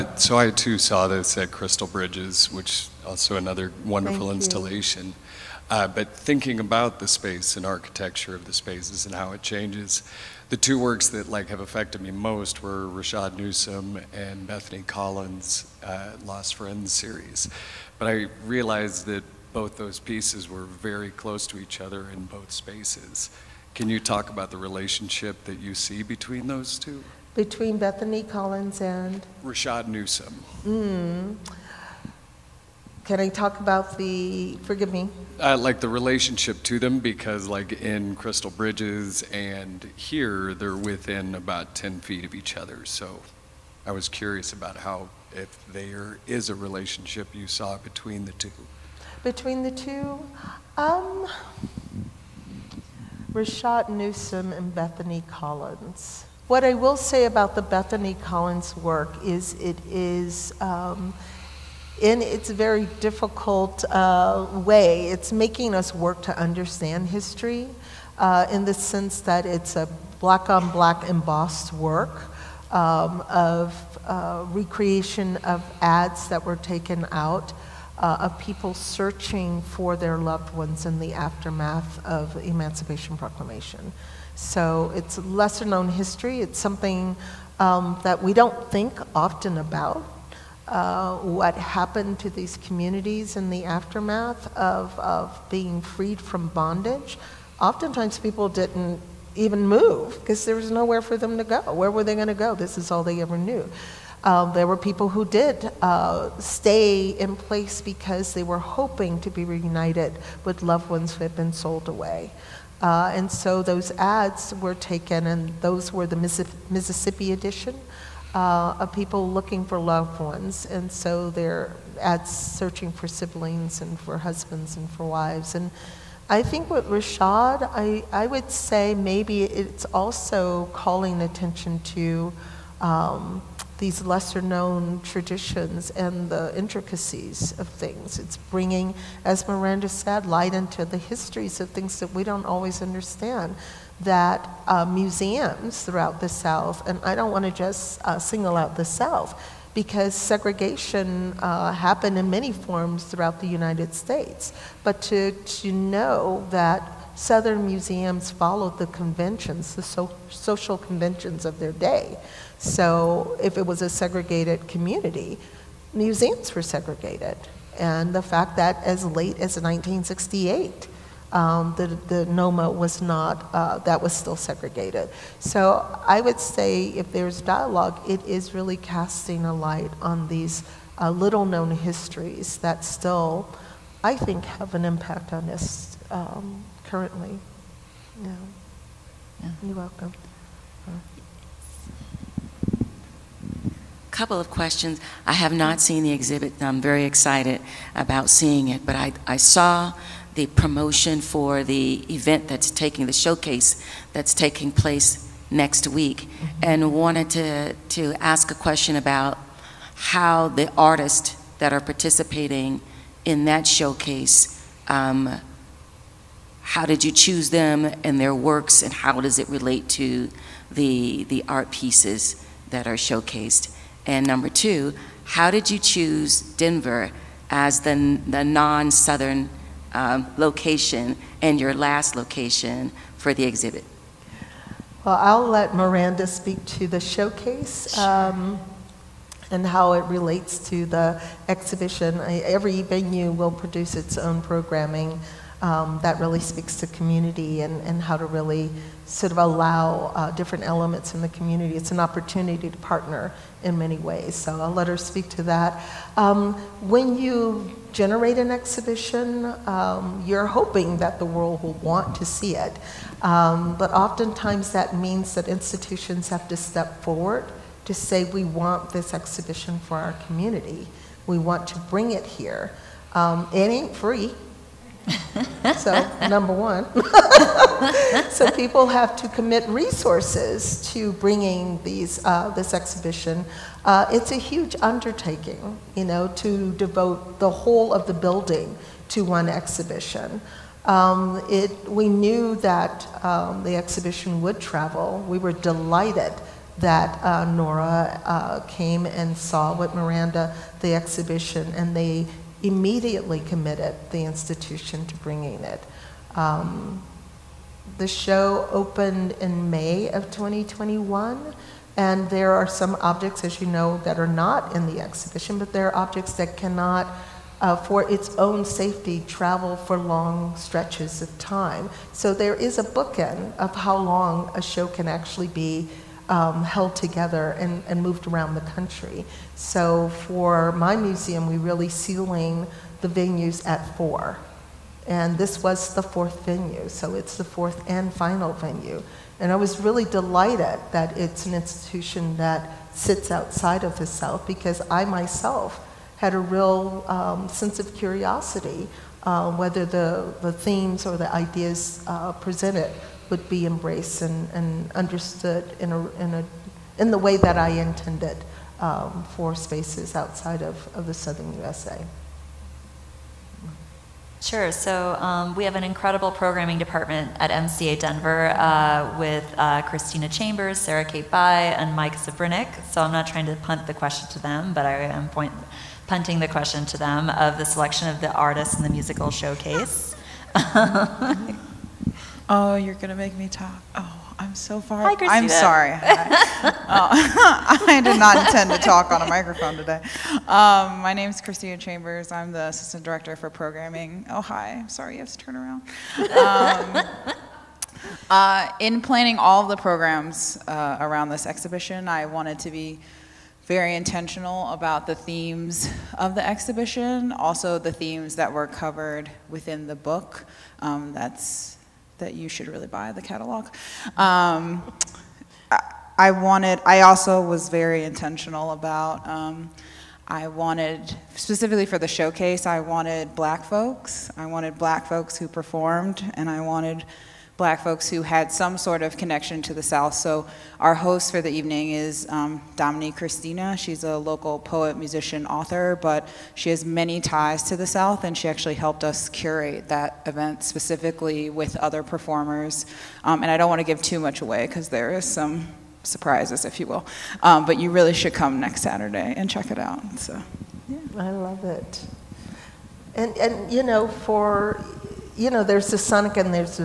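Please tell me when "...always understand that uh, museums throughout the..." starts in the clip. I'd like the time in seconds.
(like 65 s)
142 s.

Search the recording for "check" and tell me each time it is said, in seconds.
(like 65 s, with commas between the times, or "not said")
449 s.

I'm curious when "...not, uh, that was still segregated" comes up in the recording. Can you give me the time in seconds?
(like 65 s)
173 s.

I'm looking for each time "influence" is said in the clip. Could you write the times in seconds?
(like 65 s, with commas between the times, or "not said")
not said.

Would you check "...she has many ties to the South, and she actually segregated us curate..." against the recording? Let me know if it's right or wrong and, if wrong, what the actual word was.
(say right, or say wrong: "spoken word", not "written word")
wrong: "helped", not "segregated".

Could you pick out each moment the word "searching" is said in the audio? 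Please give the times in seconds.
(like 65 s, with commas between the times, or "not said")
78 s, 122 s.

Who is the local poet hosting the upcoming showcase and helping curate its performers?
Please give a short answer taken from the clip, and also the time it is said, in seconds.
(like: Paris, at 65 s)
Dominique Christina, at 432 s.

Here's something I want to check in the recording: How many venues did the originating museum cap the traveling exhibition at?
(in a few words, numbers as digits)
4.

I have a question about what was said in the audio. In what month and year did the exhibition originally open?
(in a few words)
May 2021.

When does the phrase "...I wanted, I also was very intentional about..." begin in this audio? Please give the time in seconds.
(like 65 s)
416 s.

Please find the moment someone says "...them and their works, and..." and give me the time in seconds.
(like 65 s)
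217 s.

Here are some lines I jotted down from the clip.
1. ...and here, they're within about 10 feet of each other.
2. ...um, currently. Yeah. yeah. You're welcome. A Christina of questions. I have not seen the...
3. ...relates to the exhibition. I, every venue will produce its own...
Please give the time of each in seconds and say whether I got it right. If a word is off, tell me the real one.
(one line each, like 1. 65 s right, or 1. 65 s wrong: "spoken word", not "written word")
1. 39 s right
2. 186 s wrong: "Couple", not "Christina"
3. 240 s right.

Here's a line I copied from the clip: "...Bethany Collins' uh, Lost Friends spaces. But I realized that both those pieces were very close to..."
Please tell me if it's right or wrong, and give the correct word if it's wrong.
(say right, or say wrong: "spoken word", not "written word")
wrong: "series", not "spaces".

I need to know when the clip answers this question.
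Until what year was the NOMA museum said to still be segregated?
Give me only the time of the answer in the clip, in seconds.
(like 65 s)
169 s.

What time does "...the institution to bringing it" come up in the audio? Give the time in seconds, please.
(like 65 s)
304 s.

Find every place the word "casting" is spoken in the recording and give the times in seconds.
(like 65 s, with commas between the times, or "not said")
178 s.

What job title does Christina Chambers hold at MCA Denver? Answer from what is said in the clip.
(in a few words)
Assistant Director for Programming.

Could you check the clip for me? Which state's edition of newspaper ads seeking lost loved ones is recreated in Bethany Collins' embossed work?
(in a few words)
Mississippi.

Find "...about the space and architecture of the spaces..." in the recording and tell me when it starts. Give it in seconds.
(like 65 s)
6 s.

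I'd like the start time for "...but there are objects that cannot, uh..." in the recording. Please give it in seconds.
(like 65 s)
315 s.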